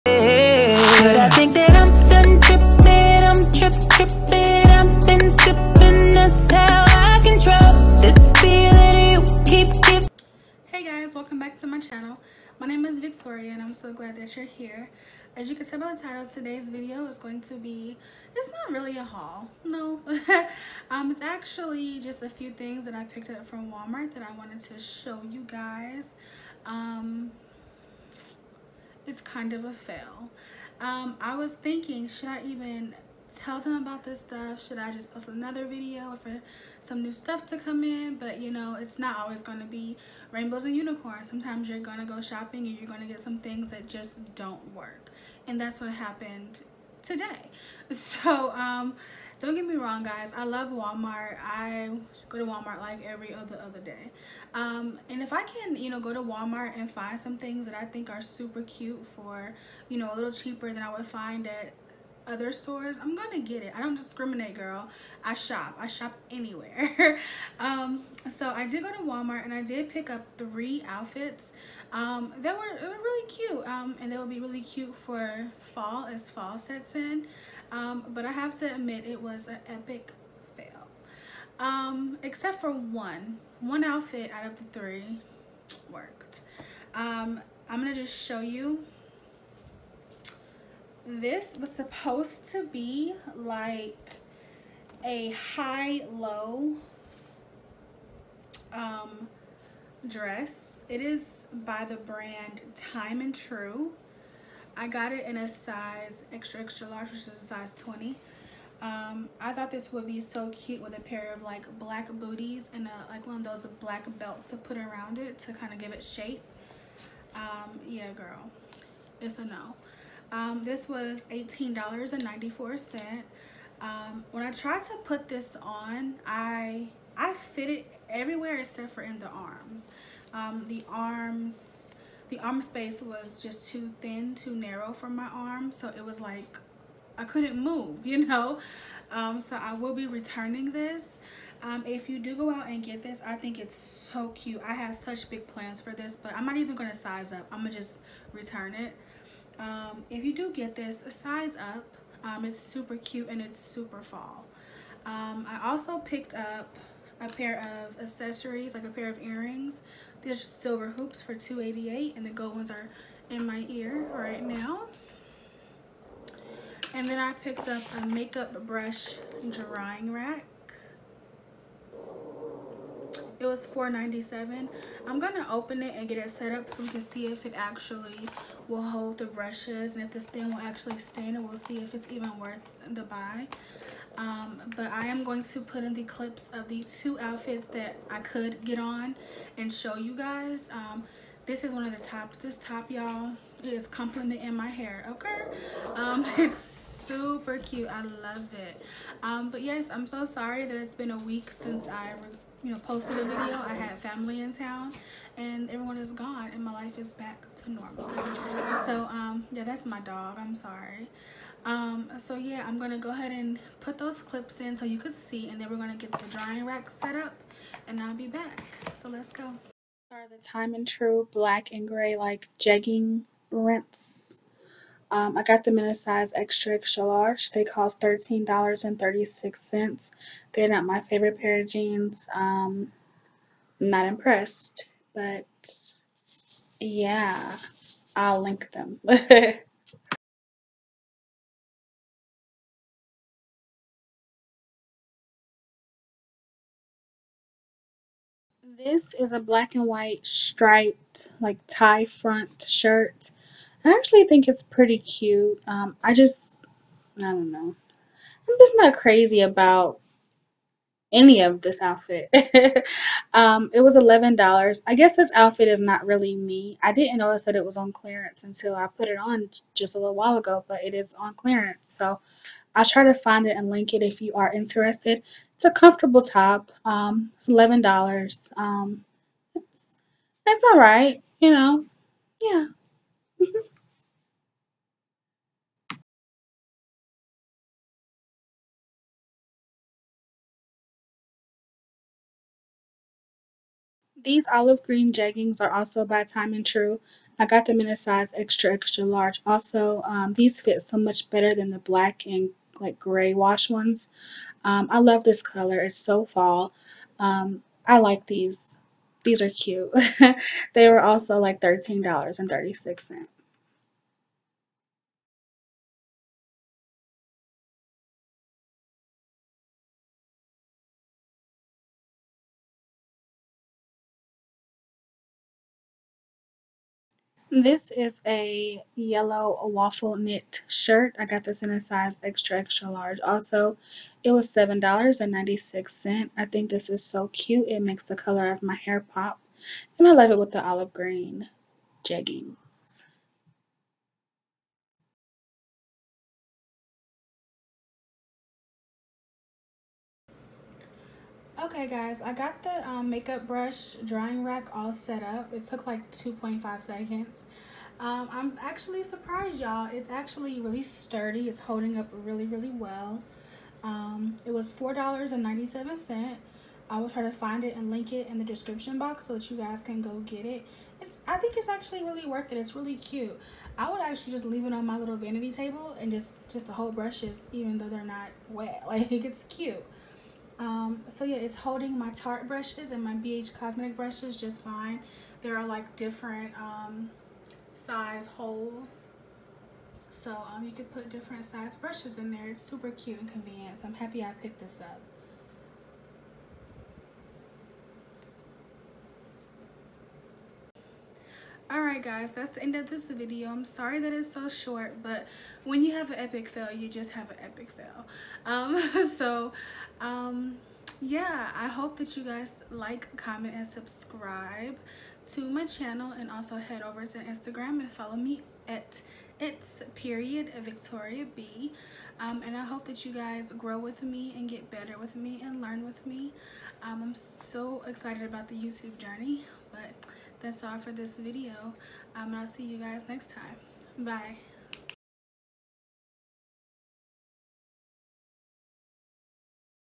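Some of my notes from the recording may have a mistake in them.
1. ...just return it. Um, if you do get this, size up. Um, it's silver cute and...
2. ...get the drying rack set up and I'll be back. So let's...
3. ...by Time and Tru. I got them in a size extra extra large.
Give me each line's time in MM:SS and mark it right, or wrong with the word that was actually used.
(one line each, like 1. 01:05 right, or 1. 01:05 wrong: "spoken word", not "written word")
1. 02:27 wrong: "super", not "silver"
2. 03:35 right
3. 04:56 right.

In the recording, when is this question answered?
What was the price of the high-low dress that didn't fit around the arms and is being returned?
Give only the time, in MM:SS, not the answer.
02:01.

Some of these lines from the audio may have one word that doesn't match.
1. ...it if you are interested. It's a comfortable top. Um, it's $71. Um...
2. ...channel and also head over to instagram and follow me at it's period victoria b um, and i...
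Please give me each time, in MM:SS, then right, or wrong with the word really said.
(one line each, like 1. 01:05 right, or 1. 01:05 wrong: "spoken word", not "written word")
1. 04:33 wrong: "11", not "71"
2. 06:55 right.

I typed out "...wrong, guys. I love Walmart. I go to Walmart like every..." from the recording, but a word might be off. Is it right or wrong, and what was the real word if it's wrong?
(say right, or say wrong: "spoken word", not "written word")
right.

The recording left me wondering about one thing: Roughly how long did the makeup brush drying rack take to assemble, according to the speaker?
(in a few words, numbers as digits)
2.5 seconds.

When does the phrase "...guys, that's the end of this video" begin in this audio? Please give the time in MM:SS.
06:42.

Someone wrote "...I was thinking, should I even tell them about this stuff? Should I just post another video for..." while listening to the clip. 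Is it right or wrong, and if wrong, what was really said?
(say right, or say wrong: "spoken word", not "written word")
right.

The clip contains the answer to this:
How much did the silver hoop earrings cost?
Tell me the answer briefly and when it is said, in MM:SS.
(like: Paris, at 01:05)
$2.88, at 02:41.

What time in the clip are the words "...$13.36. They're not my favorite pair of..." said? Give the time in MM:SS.
03:48.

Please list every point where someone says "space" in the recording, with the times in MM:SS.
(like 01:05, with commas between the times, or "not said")
02:12.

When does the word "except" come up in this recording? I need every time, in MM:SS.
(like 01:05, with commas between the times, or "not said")
01:22, 02:08.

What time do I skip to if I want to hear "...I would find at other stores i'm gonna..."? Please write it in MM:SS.
01:00.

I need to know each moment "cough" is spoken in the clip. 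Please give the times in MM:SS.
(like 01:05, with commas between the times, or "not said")
not said.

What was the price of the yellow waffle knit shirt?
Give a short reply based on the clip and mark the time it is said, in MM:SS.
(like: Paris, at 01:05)
$7.96, at 05:34.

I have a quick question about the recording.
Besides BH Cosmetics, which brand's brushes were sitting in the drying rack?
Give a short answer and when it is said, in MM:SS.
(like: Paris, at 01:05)
Tarte, at 06:22.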